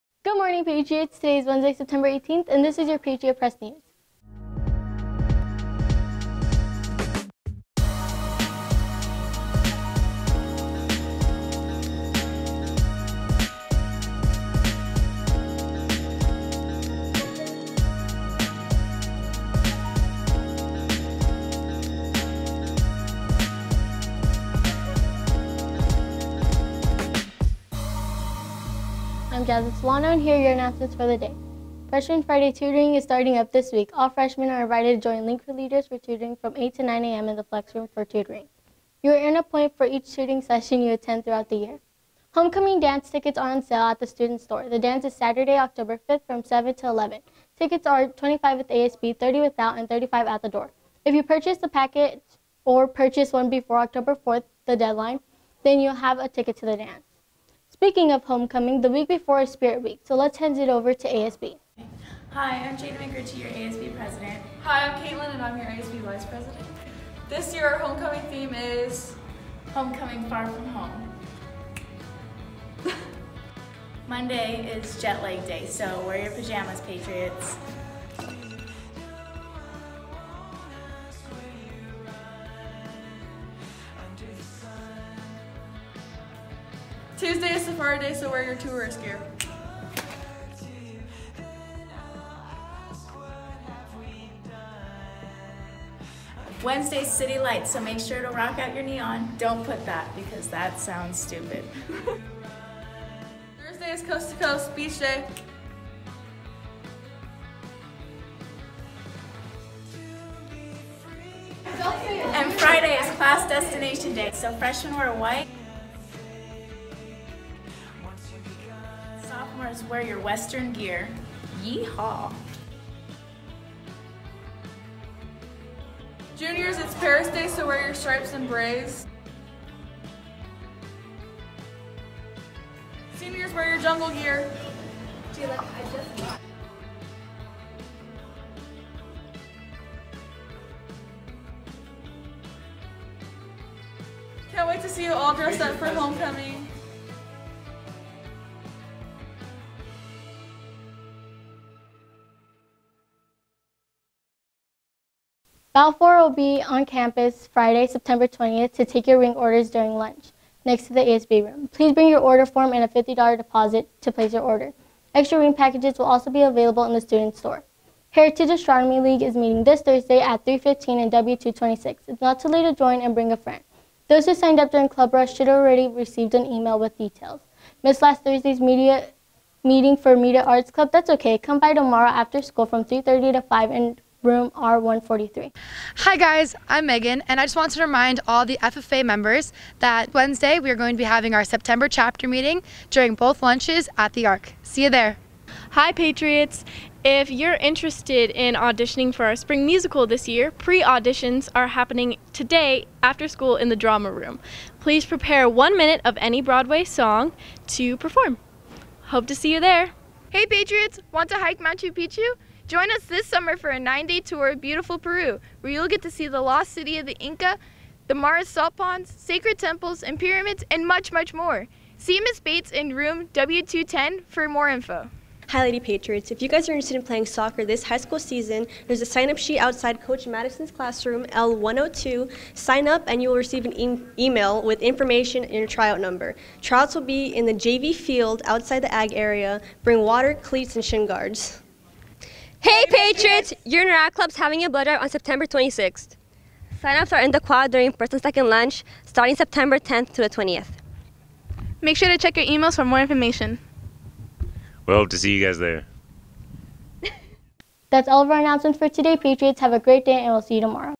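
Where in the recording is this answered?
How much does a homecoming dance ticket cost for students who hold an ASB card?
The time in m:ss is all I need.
0:47.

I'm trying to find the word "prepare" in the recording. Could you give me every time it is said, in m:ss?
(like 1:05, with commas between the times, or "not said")
3:25.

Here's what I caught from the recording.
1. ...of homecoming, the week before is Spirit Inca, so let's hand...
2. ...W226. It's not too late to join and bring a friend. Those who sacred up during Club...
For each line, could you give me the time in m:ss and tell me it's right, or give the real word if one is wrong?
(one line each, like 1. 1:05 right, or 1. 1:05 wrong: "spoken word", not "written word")
1. 0:58 wrong: "Week", not "Inca"
2. 2:51 wrong: "signed", not "sacred".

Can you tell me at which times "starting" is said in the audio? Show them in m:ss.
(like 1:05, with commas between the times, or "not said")
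0:33, 4:09.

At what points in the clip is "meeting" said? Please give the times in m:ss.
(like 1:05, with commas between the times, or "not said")
2:49, 2:59, 3:12.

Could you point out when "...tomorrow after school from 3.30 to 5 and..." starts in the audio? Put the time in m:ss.
3:01.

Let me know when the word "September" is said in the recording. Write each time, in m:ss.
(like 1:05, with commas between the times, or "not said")
0:01, 2:37, 3:11, 4:05, 4:09.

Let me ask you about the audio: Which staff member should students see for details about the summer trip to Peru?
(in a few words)
Ms. Bates.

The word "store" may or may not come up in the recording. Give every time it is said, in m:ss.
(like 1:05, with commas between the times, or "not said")
0:44, 2:47.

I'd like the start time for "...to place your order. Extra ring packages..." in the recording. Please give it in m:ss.
2:44.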